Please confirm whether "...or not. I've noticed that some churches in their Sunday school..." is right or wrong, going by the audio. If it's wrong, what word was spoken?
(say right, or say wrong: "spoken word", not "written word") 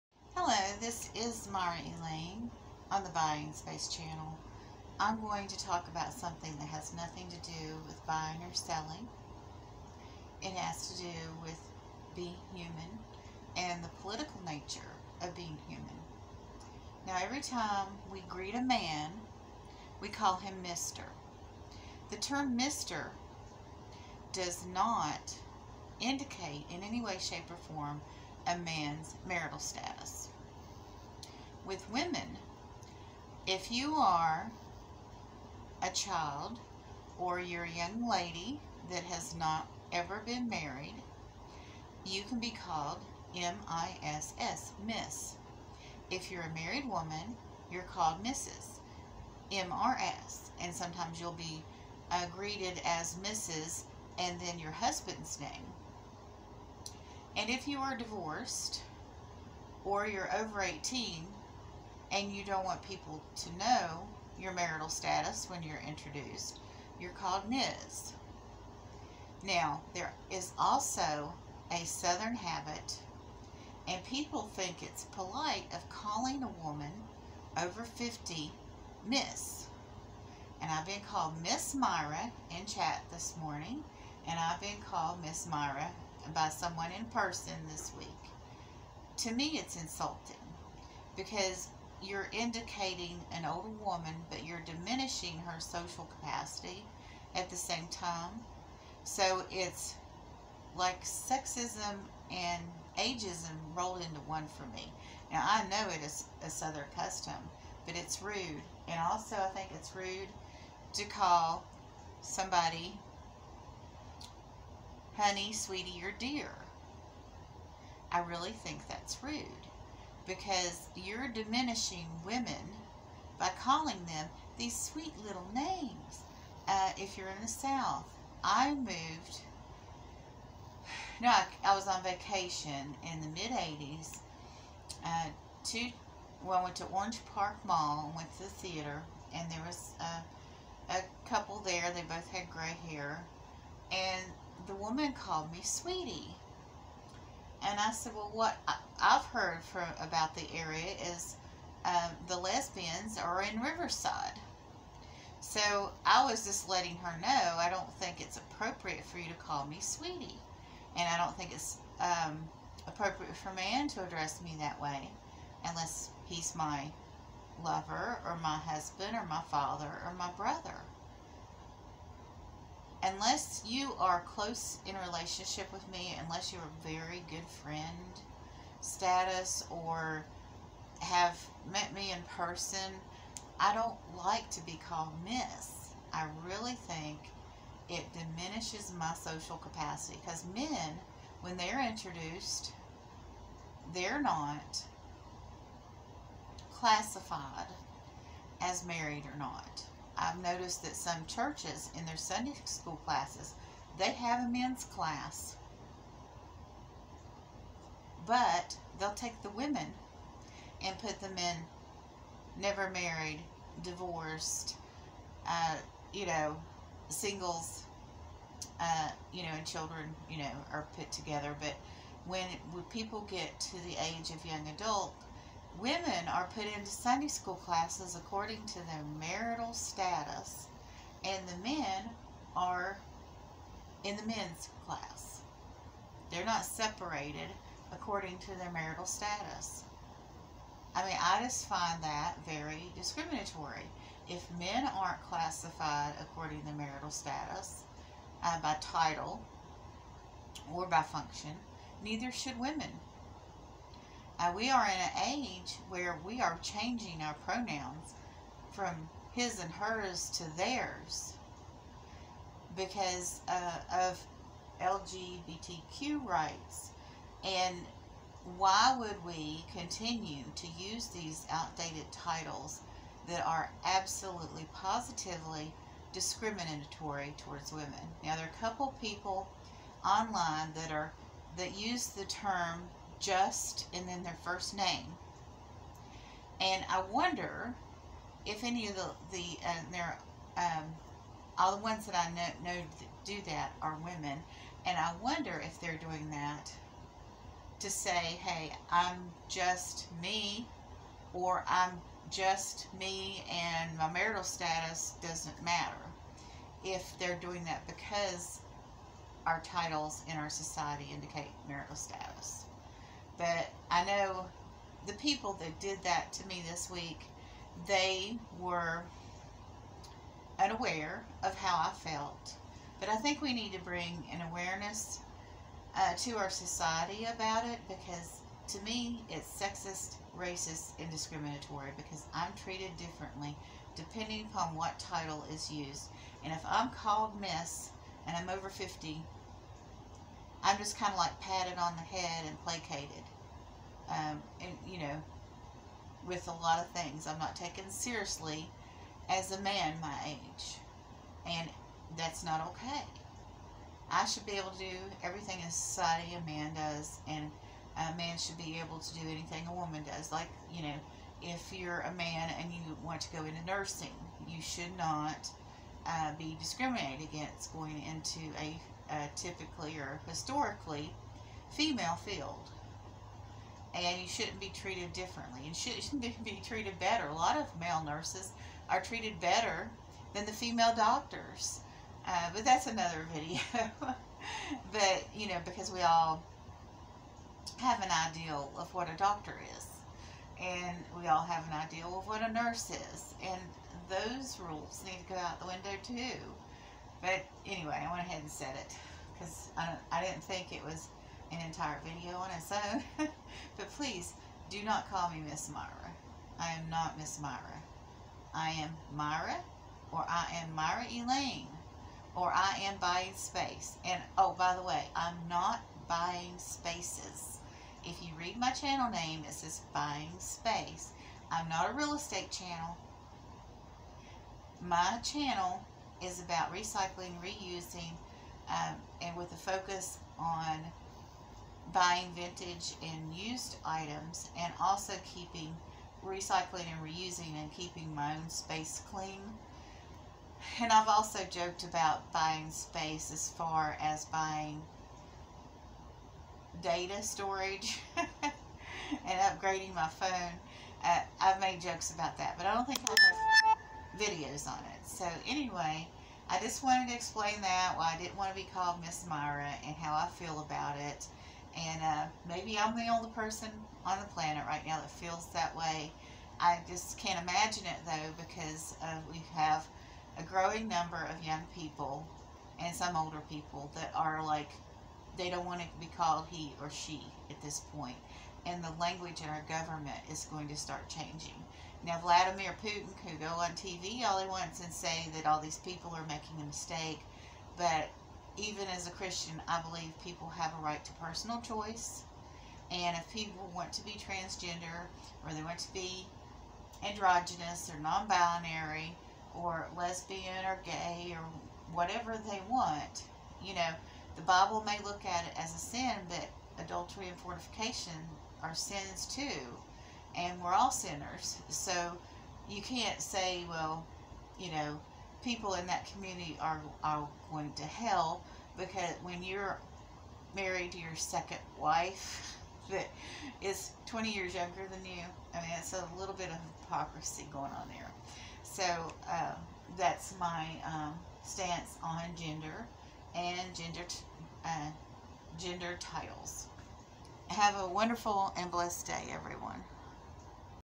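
right.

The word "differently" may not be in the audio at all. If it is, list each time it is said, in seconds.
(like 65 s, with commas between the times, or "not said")
332 s, 375 s.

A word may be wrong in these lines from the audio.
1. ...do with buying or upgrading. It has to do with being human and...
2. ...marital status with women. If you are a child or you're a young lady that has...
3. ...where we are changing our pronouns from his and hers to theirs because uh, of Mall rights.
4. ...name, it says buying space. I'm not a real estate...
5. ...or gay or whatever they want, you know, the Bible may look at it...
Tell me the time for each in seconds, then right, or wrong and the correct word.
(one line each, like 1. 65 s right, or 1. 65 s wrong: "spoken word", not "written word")
1. 7 s wrong: "selling", not "upgrading"
2. 29 s right
3. 255 s wrong: "LGBTQ", not "Mall"
4. 419 s right
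5. 500 s right.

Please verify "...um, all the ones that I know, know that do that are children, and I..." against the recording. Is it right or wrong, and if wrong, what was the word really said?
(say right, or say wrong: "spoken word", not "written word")
wrong: "women", not "children".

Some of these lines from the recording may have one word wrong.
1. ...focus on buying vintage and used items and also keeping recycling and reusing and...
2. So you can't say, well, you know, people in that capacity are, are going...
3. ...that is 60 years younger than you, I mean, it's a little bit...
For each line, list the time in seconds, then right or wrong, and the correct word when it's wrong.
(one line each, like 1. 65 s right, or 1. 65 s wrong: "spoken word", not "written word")
1. 429 s right
2. 511 s wrong: "community", not "capacity"
3. 522 s wrong: "20", not "60".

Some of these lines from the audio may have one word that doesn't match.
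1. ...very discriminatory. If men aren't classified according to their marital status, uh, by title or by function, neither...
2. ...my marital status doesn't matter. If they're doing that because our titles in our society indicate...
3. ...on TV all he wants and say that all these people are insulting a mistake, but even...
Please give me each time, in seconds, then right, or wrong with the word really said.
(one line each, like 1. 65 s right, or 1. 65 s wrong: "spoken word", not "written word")
1. 242 s right
2. 303 s right
3. 483 s wrong: "making", not "insulting".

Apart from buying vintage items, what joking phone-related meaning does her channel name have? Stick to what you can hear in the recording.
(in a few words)
data storage.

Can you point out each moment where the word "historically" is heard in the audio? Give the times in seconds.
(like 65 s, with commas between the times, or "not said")
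370 s.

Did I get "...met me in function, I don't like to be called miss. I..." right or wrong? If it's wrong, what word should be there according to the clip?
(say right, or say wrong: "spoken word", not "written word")
wrong: "person", not "function".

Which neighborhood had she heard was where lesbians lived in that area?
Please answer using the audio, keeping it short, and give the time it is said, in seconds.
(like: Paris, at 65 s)
Riverside, at 153 s.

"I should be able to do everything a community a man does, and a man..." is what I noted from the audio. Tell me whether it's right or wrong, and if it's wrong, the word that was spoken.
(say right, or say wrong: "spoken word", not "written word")
wrong: "society", not "community".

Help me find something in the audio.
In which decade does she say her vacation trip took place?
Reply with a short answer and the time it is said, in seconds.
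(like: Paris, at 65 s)
mid 80s, at 133 s.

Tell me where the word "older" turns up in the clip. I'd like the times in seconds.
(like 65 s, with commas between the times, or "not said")
93 s, 473 s.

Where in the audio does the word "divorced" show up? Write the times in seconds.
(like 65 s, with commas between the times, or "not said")
57 s, 213 s.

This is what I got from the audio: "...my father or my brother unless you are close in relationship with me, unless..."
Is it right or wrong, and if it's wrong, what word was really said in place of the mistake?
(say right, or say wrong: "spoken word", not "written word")
right.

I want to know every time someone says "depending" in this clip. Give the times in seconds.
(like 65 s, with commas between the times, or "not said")
333 s.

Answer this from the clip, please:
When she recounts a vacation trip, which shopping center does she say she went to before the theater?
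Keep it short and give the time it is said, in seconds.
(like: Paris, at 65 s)
Orange Park Mall, at 136 s.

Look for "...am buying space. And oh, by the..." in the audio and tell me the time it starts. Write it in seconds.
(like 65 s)
412 s.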